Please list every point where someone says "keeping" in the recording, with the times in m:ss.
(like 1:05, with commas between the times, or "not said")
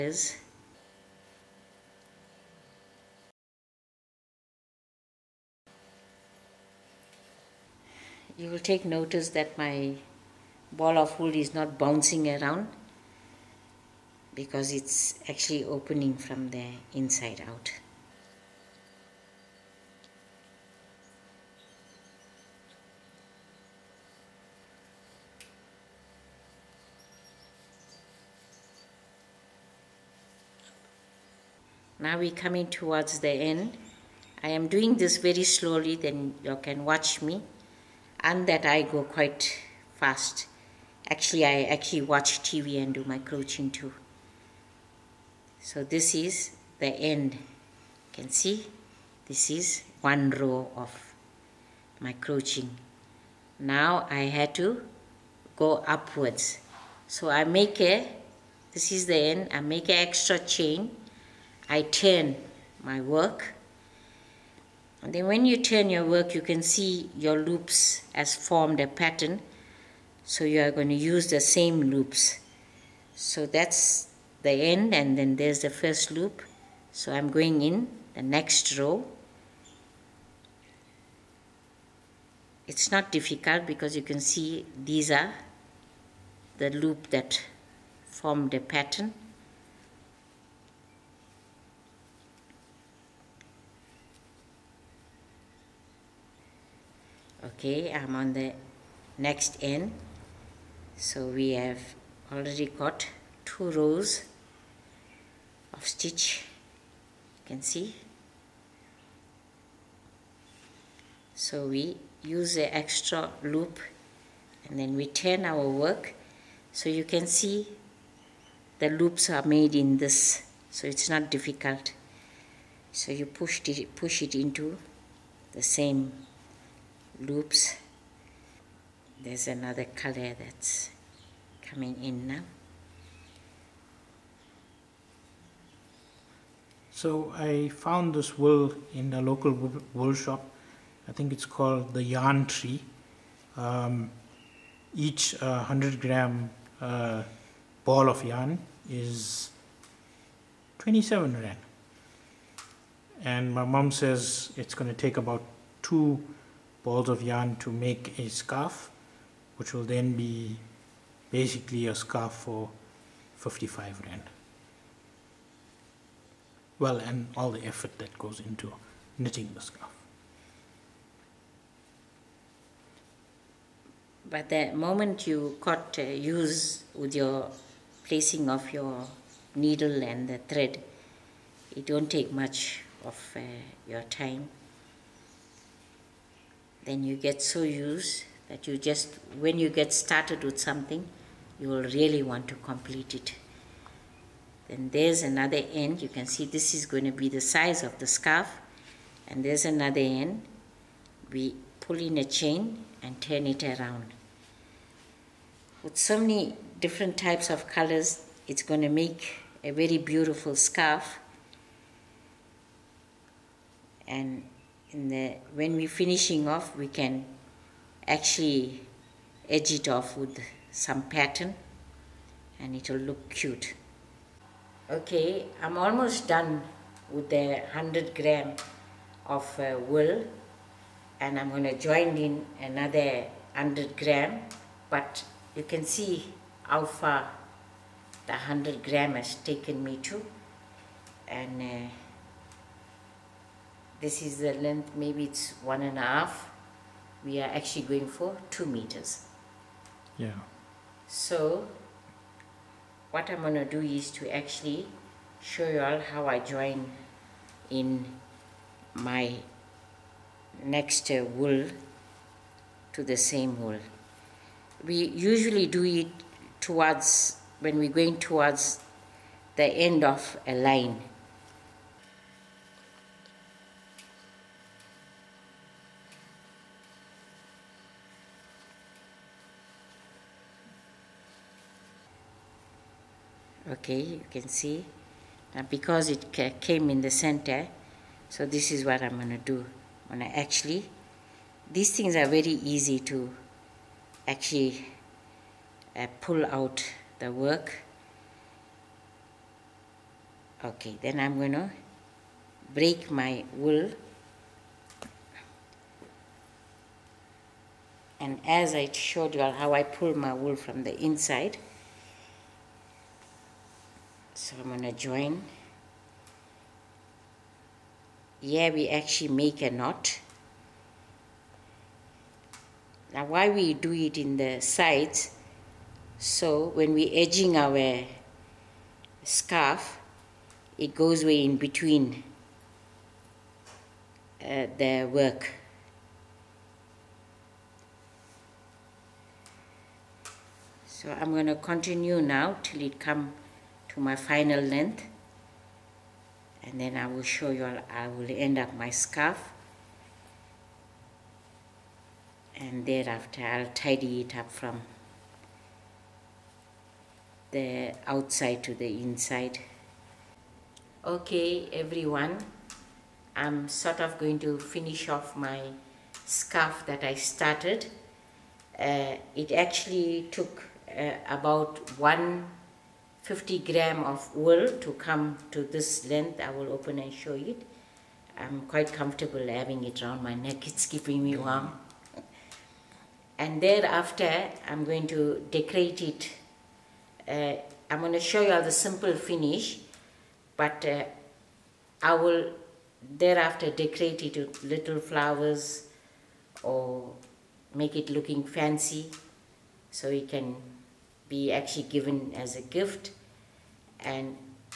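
6:20.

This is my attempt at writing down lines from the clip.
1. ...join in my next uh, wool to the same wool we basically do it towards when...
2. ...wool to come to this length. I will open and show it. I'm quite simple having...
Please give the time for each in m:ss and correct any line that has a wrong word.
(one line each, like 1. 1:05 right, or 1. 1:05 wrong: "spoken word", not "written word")
1. 4:16 wrong: "usually", not "basically"
2. 6:14 wrong: "comfortable", not "simple".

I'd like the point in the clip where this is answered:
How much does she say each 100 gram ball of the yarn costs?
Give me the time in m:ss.
2:30.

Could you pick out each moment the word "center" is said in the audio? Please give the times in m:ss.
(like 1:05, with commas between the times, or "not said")
4:47.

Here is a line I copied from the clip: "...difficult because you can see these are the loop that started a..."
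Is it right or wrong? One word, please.
wrong.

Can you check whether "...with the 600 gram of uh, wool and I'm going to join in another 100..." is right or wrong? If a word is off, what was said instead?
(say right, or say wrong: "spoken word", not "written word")
wrong: "100", not "600".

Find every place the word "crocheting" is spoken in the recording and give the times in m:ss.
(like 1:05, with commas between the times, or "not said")
0:43, 0:52.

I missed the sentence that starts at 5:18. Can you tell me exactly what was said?
Yeah, we actually make a knot.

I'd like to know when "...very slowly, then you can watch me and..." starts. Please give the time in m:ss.
0:35.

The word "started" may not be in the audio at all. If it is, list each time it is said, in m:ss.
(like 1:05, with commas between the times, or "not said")
3:09, 6:07.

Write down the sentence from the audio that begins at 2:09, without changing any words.
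There's another color that's coming in now.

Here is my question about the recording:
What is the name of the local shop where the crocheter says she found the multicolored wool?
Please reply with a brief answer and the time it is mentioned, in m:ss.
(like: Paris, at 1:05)
The Yarn Tree, at 2:22.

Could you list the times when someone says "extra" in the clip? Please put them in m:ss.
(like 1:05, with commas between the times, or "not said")
1:00, 1:52.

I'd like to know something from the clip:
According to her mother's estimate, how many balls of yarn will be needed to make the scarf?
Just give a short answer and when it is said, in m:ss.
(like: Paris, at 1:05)
2, at 2:35.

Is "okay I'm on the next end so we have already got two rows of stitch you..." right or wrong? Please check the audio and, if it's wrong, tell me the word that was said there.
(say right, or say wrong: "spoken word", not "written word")
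right.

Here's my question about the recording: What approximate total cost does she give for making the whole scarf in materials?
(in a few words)
55 rand.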